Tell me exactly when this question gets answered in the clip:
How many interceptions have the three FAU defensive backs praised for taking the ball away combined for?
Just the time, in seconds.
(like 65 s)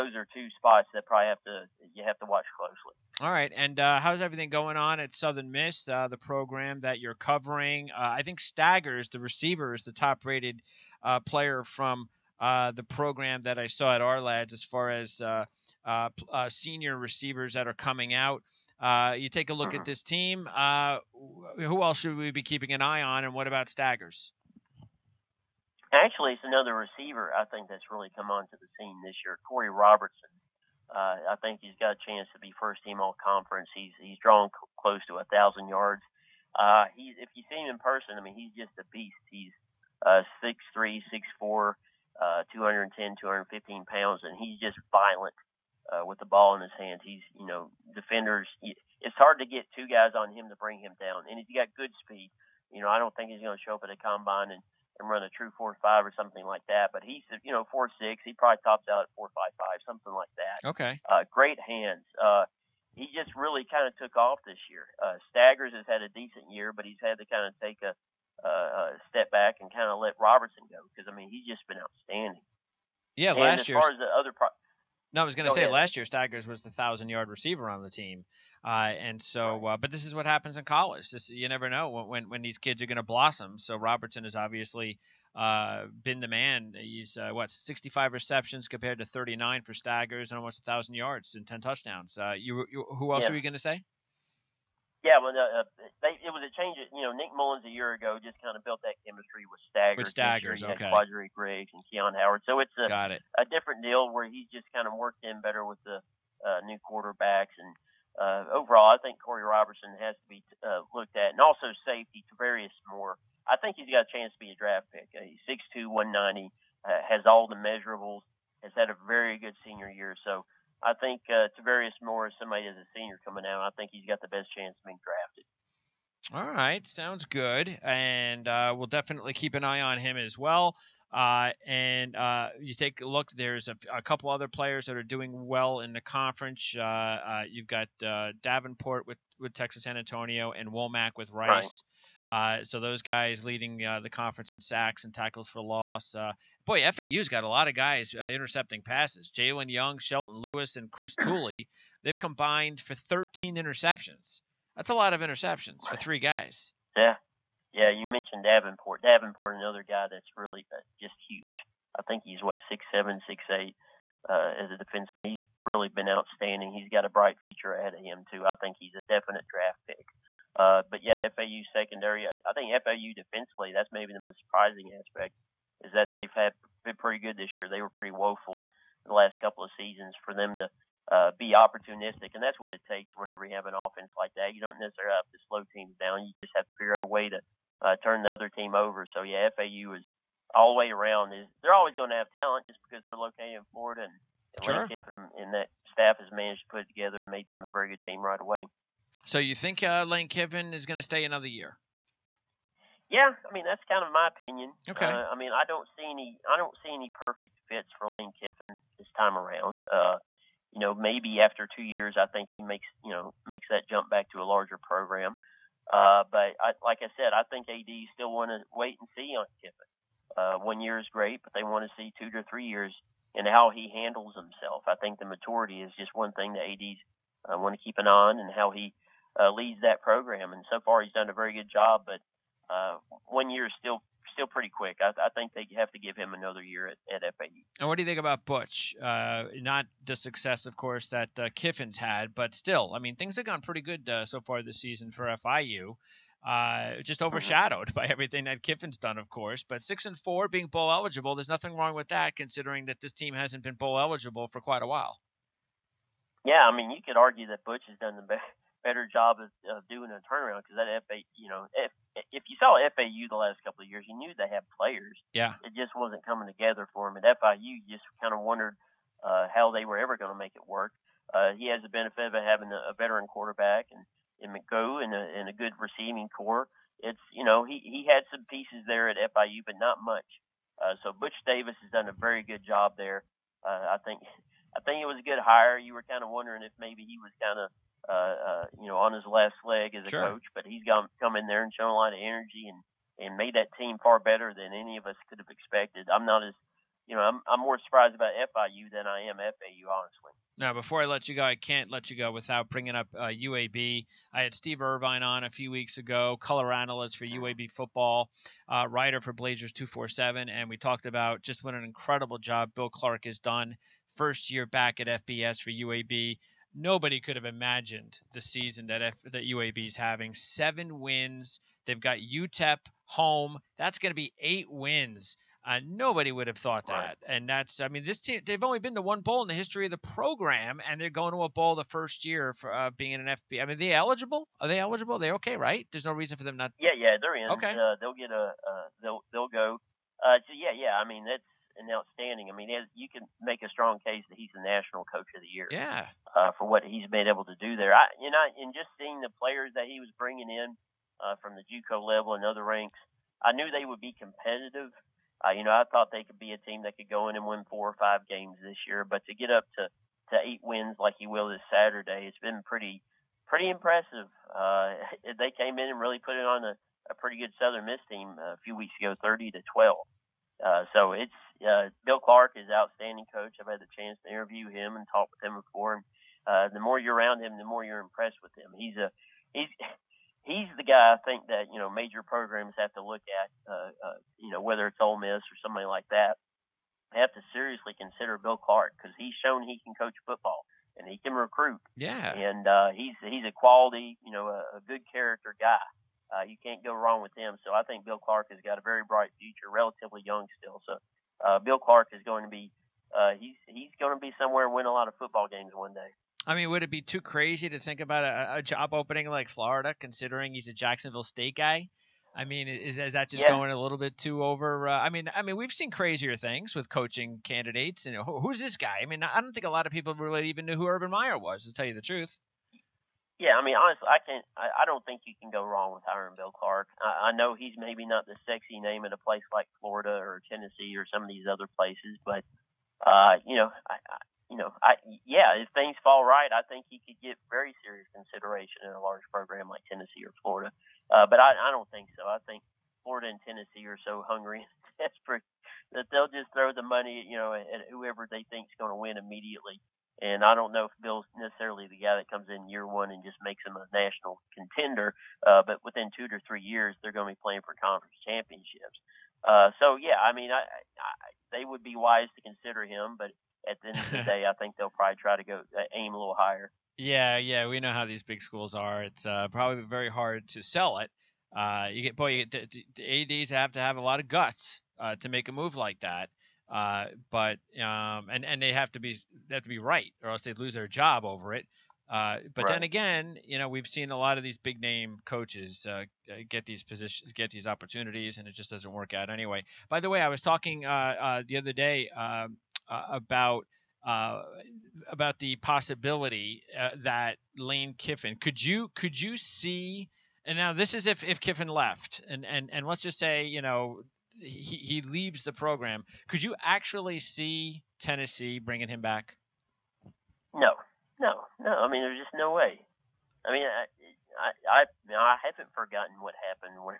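152 s.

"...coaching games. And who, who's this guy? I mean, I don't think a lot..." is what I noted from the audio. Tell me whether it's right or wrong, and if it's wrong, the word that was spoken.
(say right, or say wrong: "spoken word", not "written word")
wrong: "candidates", not "games".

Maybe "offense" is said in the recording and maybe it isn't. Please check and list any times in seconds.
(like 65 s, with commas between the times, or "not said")
183 s.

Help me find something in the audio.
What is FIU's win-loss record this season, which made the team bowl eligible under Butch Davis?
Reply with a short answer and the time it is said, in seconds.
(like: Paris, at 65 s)
6-4, at 249 s.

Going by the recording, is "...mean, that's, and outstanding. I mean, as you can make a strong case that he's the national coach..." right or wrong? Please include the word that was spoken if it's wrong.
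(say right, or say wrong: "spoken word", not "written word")
right.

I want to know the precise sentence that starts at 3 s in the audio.
All right, and uh, how's everything going on at Southern Miss, uh, the program that you're covering?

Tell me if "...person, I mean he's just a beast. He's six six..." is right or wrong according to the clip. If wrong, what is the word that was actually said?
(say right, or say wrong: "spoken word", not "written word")
wrong: "three", not "six".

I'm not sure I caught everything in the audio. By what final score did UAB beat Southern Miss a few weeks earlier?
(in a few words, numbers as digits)
30 to 12.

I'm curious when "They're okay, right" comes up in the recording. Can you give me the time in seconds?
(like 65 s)
335 s.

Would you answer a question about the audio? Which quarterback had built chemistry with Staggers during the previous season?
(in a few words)
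Nick Mullens.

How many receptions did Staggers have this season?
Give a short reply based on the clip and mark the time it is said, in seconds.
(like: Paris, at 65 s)
39, at 89 s.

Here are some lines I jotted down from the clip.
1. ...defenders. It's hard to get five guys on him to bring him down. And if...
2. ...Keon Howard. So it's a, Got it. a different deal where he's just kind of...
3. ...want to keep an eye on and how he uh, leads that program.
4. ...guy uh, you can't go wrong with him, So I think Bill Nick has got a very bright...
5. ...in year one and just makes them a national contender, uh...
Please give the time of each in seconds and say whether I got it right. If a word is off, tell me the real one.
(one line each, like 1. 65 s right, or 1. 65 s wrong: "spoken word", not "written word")
1. 47 s wrong: "two", not "five"
2. 101 s right
3. 227 s right
4. 395 s wrong: "Clark", not "Nick"
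5. 452 s right.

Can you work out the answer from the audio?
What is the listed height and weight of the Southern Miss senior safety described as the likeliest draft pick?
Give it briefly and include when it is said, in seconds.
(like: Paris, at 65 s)
6'2", 190, at 115 s.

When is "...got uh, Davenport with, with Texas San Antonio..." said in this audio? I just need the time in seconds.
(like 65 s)
137 s.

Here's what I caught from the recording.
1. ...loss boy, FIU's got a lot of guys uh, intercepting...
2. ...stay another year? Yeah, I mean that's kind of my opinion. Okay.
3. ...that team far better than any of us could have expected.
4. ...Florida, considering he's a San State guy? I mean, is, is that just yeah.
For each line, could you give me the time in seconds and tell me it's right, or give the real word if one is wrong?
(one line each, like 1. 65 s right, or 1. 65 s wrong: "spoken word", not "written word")
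1. 145 s wrong: "FAU", not "FIU"
2. 201 s right
3. 293 s right
4. 409 s wrong: "Jacksonville", not "San".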